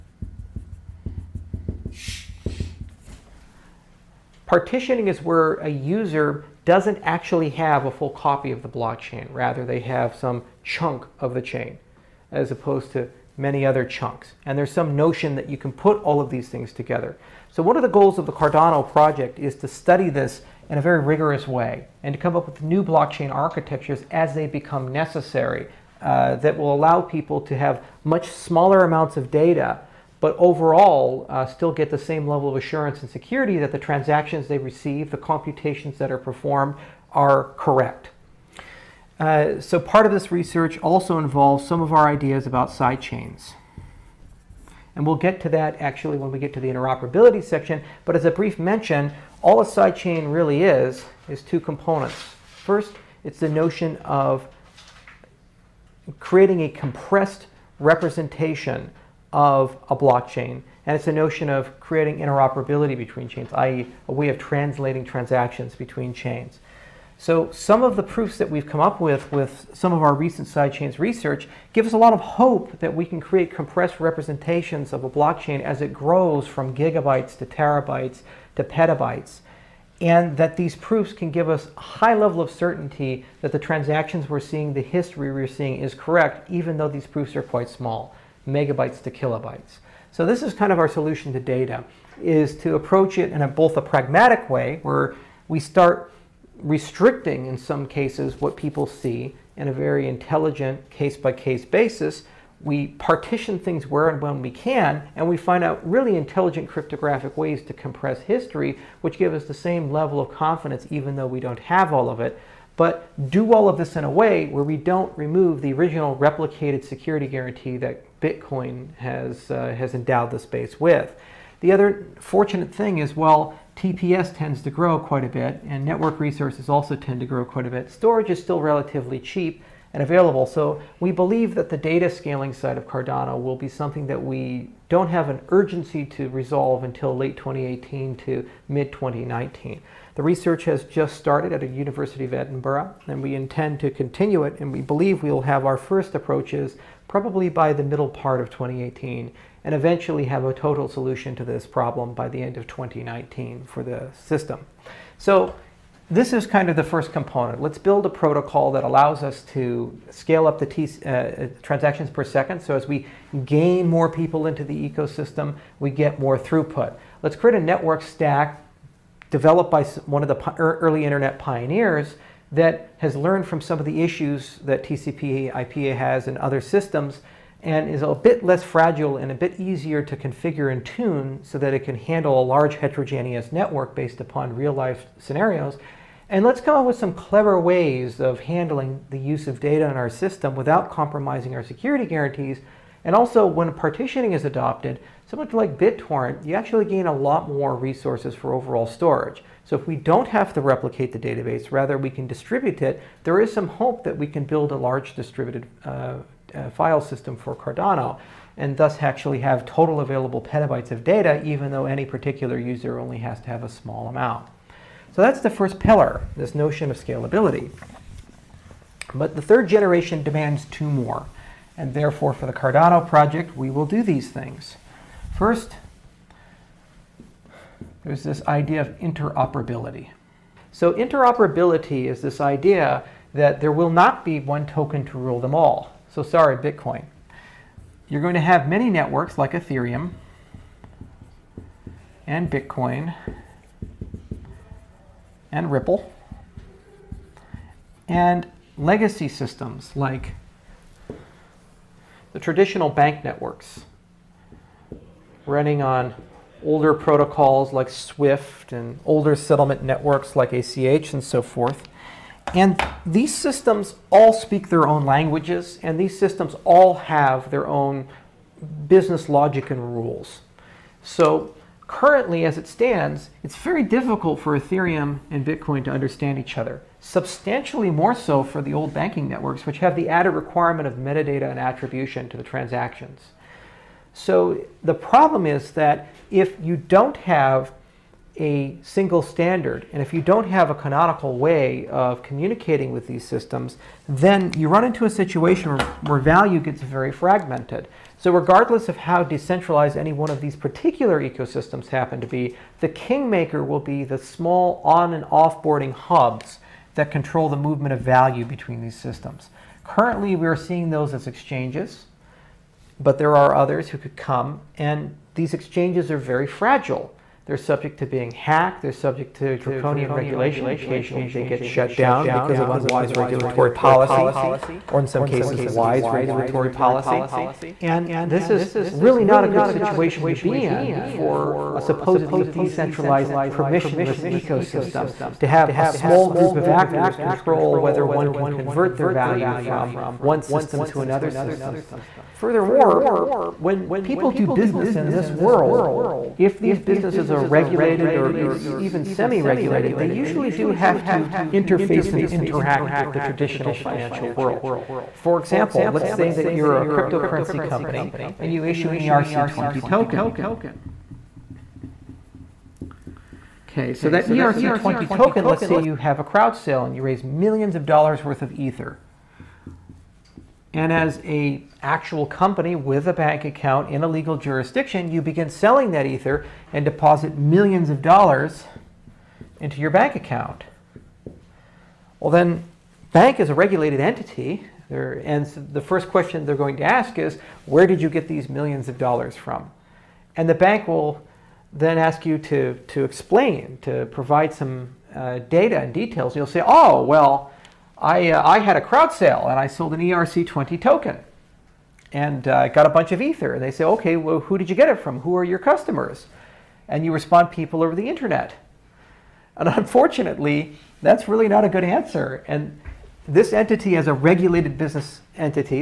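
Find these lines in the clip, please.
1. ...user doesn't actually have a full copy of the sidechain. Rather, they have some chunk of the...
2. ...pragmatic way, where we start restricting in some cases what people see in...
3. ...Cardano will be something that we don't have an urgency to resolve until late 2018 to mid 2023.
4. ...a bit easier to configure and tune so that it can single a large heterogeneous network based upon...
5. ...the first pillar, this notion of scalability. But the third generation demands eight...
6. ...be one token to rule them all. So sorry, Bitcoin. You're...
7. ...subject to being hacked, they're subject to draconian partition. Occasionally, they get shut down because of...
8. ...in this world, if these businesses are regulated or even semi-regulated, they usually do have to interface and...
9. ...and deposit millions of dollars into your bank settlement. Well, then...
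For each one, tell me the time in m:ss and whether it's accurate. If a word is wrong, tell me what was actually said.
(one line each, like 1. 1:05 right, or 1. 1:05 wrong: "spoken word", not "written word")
1. 0:05 wrong: "blockchain", not "sidechain"
2. 1:33 right
3. 2:12 wrong: "2019", not "2023"
4. 2:59 wrong: "handle", not "single"
5. 3:35 wrong: "two", not "eight"
6. 3:54 right
7. 5:17 wrong: "regulation", not "partition"
8. 5:44 right
9. 6:16 wrong: "account", not "settlement".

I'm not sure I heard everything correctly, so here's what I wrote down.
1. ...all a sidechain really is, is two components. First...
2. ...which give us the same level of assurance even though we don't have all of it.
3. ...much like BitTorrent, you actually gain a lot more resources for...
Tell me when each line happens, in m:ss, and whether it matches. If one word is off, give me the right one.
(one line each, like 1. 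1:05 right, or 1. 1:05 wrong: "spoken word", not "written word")
1. 0:49 right
2. 1:49 wrong: "confidence", not "assurance"
3. 3:15 right.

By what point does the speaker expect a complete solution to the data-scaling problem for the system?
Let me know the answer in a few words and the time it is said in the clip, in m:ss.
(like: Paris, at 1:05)
end of 2019, at 2:32.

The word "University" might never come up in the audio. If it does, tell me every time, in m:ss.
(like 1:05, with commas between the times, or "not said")
2:21.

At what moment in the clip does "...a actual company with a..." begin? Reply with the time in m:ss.
6:11.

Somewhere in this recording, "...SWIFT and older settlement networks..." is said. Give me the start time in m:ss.
4:17.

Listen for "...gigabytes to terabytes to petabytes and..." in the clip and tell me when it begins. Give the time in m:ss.
1:16.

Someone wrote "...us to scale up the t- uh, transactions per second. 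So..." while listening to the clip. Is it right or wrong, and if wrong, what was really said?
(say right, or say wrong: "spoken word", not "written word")
right.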